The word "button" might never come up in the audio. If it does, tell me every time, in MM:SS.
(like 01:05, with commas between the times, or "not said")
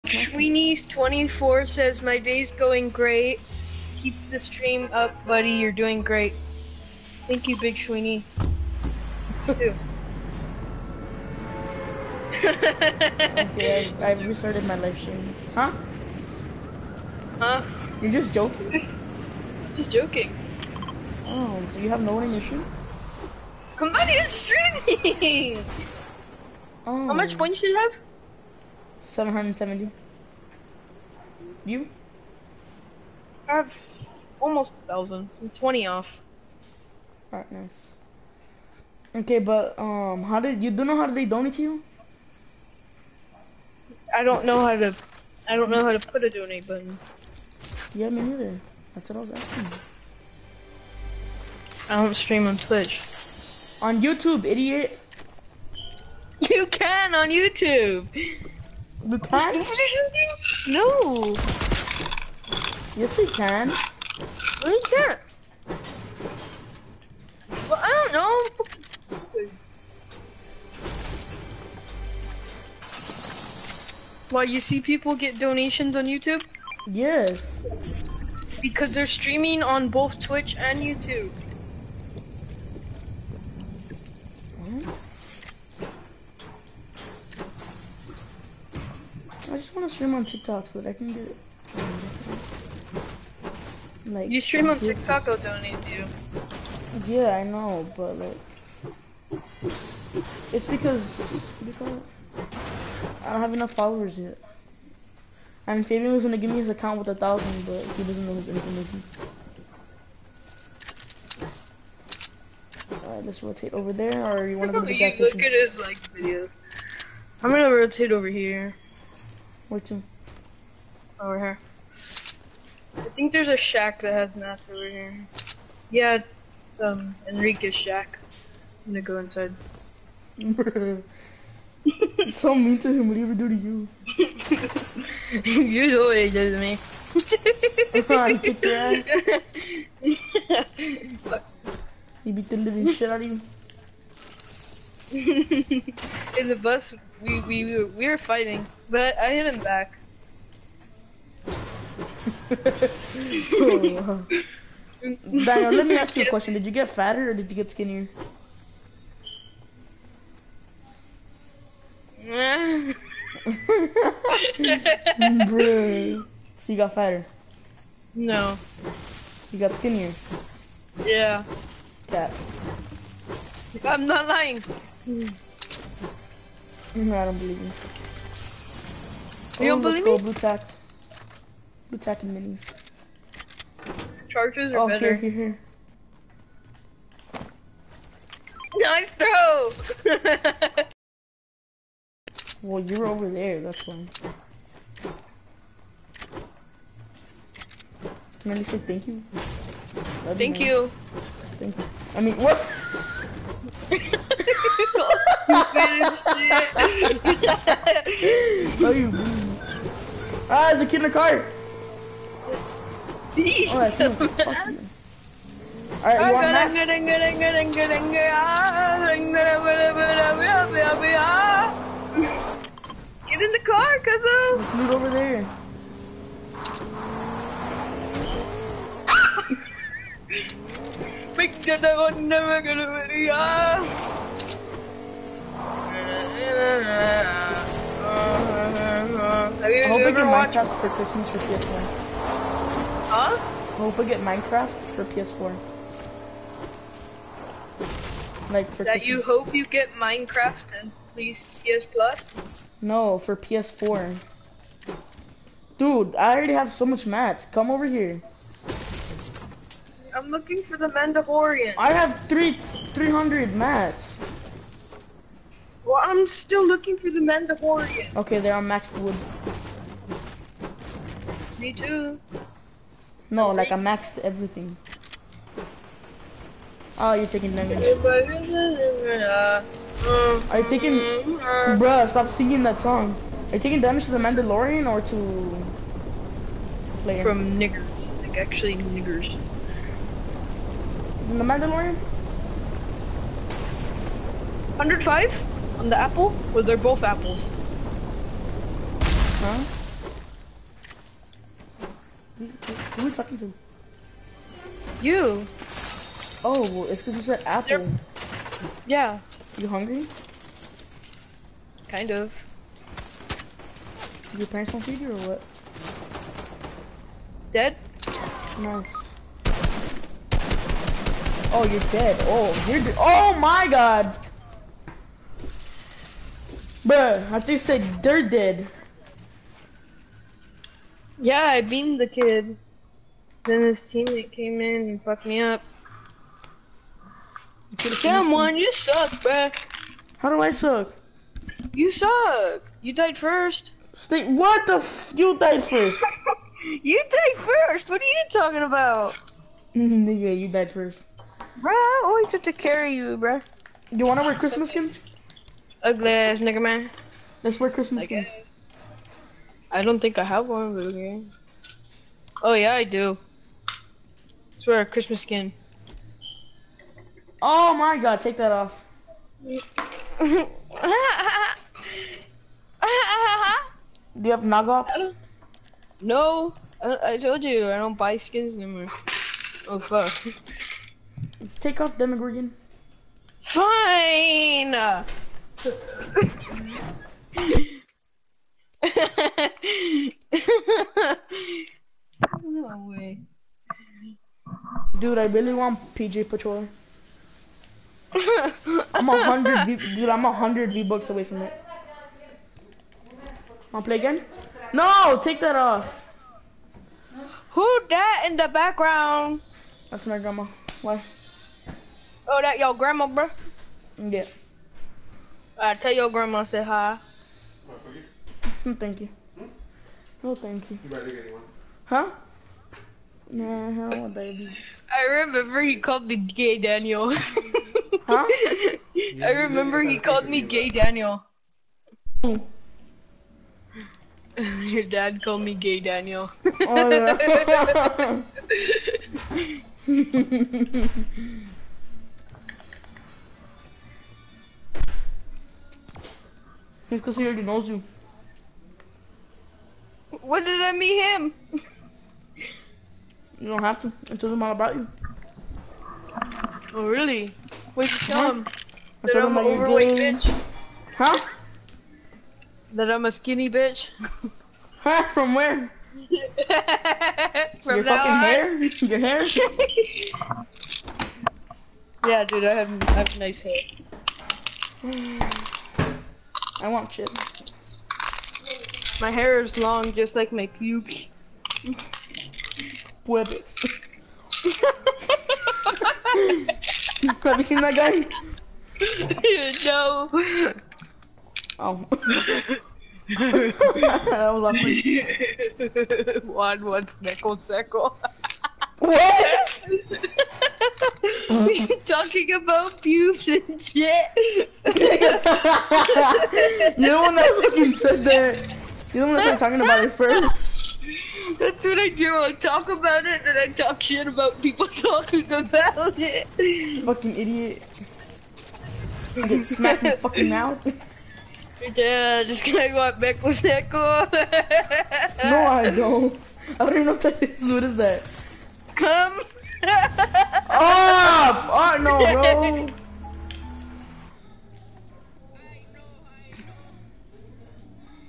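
00:46.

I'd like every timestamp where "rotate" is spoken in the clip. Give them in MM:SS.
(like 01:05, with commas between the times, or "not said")
01:53, 01:57.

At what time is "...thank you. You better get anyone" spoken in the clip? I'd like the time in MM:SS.
07:00.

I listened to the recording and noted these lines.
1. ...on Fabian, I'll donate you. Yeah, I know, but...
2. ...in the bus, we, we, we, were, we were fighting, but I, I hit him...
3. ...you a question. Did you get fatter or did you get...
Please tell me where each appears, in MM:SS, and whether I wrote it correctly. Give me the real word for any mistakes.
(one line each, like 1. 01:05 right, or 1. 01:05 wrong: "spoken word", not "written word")
1. 01:34 wrong: "TikTok", not "Fabian"
2. 02:25 right
3. 02:36 right.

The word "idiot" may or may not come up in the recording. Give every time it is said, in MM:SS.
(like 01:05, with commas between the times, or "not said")
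00:54, 08:37.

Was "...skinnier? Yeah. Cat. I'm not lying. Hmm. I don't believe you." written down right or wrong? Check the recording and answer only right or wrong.
right.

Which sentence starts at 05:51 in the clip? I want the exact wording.
Bruh, I always had to carry you, bruh.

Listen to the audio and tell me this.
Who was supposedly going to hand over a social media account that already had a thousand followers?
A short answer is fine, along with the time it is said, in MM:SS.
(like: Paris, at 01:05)
Fabian, at 01:45.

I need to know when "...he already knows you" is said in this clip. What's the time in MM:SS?
07:27.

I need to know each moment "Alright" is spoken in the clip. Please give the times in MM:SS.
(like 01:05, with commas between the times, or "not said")
00:37, 01:53, 03:36.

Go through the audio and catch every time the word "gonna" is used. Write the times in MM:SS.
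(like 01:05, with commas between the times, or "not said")
01:46, 01:57, 02:08, 03:52.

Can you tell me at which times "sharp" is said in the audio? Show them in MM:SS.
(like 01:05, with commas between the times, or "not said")
not said.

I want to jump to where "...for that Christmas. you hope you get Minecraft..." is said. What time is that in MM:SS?
04:08.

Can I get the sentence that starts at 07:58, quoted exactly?
My hair is long, just like my pubes puedes.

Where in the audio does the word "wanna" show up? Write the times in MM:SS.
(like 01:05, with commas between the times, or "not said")
01:54, 05:54, 06:43.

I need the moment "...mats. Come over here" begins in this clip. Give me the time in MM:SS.
04:17.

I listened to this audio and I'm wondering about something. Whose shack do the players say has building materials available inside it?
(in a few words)
Enrique.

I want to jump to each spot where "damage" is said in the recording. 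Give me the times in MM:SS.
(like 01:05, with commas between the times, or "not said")
04:37, 04:43.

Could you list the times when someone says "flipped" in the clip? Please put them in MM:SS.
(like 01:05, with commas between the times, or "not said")
not said.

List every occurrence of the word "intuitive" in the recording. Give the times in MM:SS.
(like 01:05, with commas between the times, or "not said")
not said.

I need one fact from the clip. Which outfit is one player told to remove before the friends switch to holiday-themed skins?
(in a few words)
Demogorgon.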